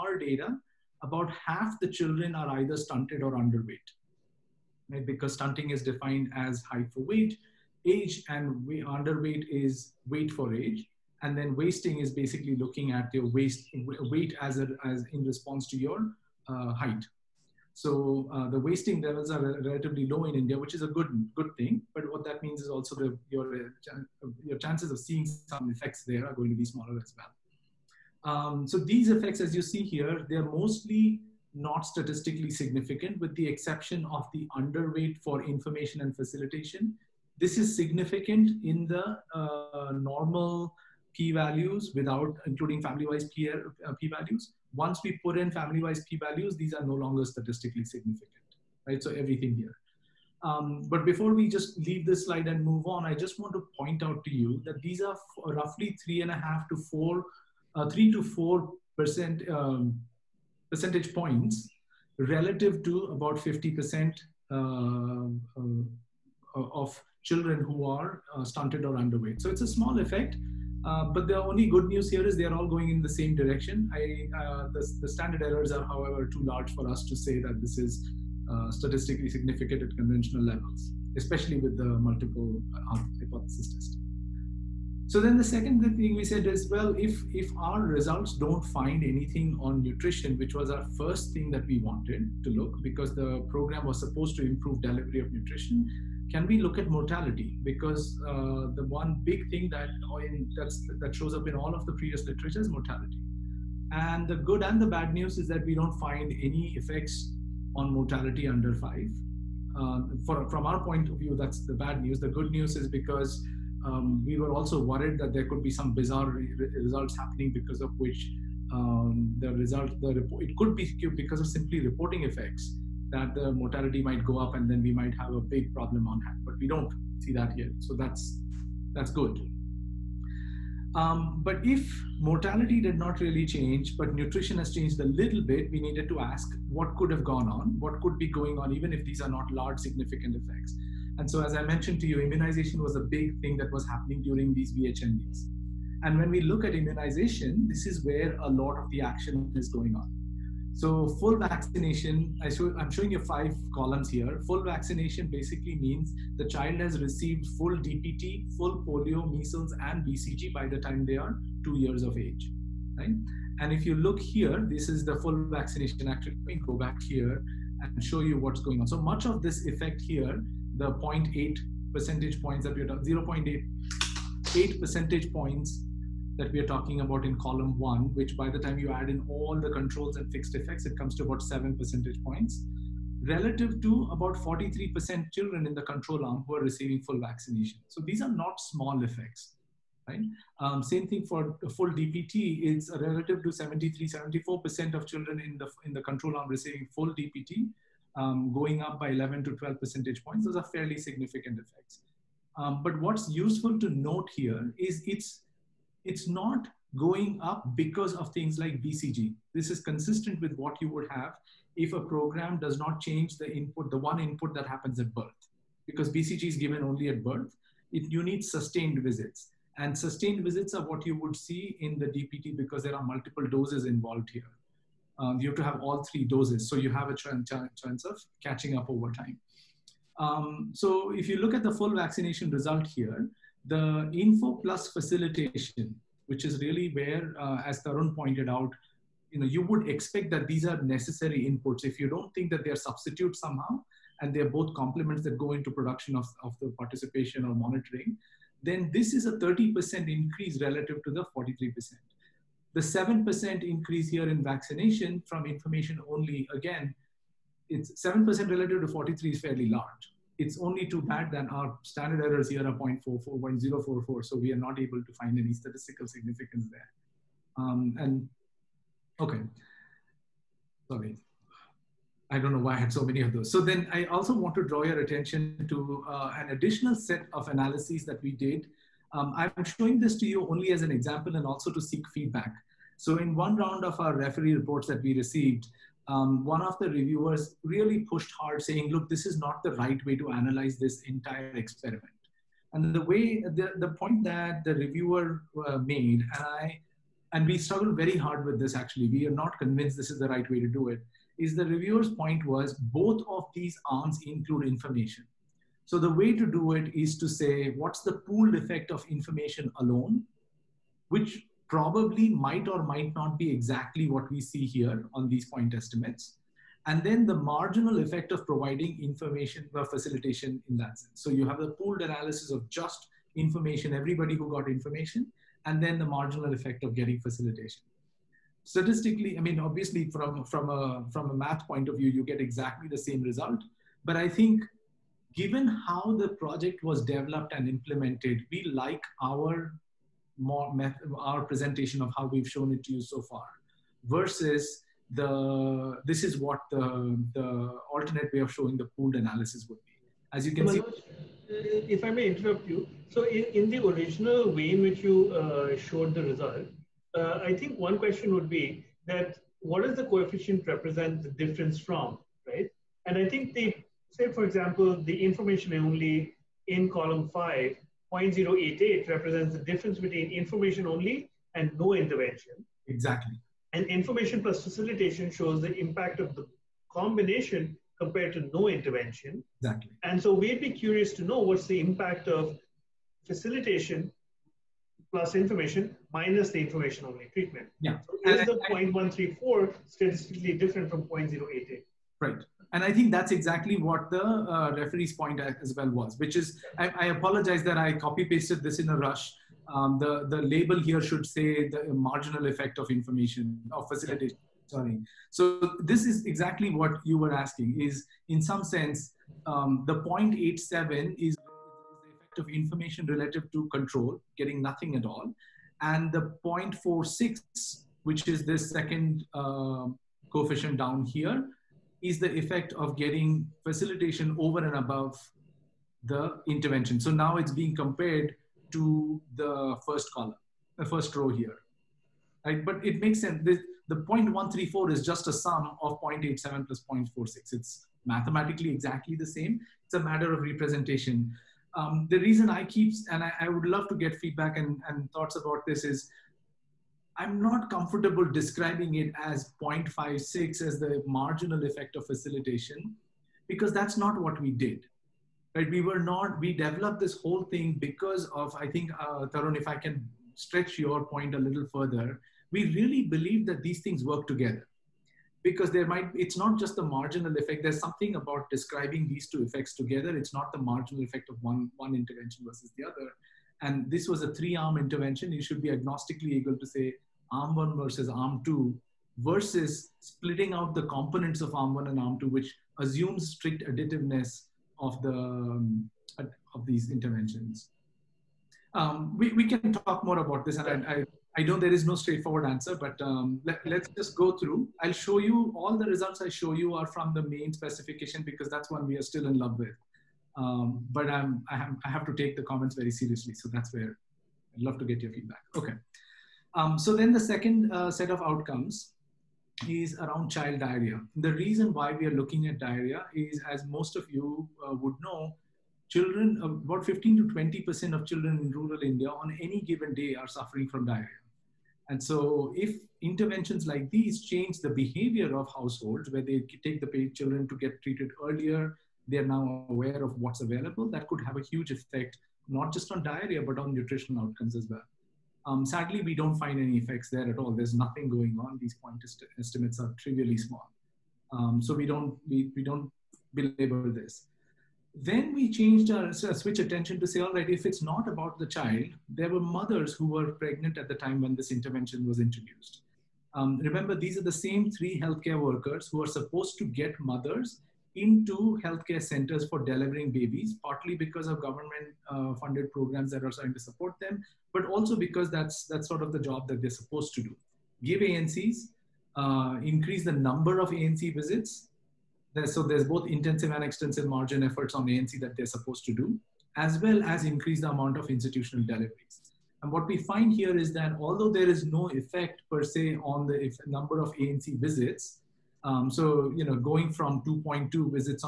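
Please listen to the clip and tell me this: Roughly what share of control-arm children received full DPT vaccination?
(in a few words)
73-74%.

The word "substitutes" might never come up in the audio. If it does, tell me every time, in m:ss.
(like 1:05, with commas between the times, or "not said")
4:02.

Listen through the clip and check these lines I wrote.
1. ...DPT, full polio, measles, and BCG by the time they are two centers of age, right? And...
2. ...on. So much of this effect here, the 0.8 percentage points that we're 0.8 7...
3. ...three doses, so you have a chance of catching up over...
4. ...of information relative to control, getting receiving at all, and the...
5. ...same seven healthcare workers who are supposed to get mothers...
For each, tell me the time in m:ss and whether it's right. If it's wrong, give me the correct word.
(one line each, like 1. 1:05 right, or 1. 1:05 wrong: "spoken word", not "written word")
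1. 2:37 wrong: "years", not "centers"
2. 2:48 wrong: "8", not "7"
3. 3:46 right
4. 6:52 wrong: "nothing", not "receiving"
5. 9:14 wrong: "three", not "seven".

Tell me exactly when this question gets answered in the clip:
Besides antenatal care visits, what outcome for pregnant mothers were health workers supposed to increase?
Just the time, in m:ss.
9:38.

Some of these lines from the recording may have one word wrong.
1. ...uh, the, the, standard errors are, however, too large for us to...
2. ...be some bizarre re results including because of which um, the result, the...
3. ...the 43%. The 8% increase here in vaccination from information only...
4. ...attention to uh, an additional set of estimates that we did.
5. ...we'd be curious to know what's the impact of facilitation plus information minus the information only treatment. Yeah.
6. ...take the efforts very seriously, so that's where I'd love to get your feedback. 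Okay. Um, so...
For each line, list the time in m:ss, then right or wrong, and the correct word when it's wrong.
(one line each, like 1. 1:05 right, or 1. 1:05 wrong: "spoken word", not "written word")
1. 1:14 right
2. 1:55 wrong: "happening", not "including"
3. 4:11 wrong: "7", not "8"
4. 4:34 wrong: "analyses", not "estimates"
5. 6:20 right
6. 8:22 wrong: "comments", not "efforts".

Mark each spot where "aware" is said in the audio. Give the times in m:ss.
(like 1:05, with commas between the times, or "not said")
8:49.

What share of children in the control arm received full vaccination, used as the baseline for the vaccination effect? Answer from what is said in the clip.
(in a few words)
43%.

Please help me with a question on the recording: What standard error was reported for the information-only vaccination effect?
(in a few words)
0.044.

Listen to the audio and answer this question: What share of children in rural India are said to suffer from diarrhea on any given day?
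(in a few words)
15 to 20%.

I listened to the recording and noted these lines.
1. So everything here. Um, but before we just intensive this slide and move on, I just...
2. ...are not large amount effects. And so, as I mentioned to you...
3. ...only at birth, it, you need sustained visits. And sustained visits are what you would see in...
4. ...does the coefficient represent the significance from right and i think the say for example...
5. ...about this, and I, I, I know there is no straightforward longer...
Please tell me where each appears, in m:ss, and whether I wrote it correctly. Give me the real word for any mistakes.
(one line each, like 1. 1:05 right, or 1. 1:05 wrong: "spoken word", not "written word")
1. 0:49 wrong: "leave", not "intensive"
2. 2:19 wrong: "significant", not "amount"
3. 3:36 right
4. 5:59 wrong: "difference", not "significance"
5. 8:10 wrong: "answer", not "longer".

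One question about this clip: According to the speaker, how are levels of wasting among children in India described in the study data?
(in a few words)
relatively low.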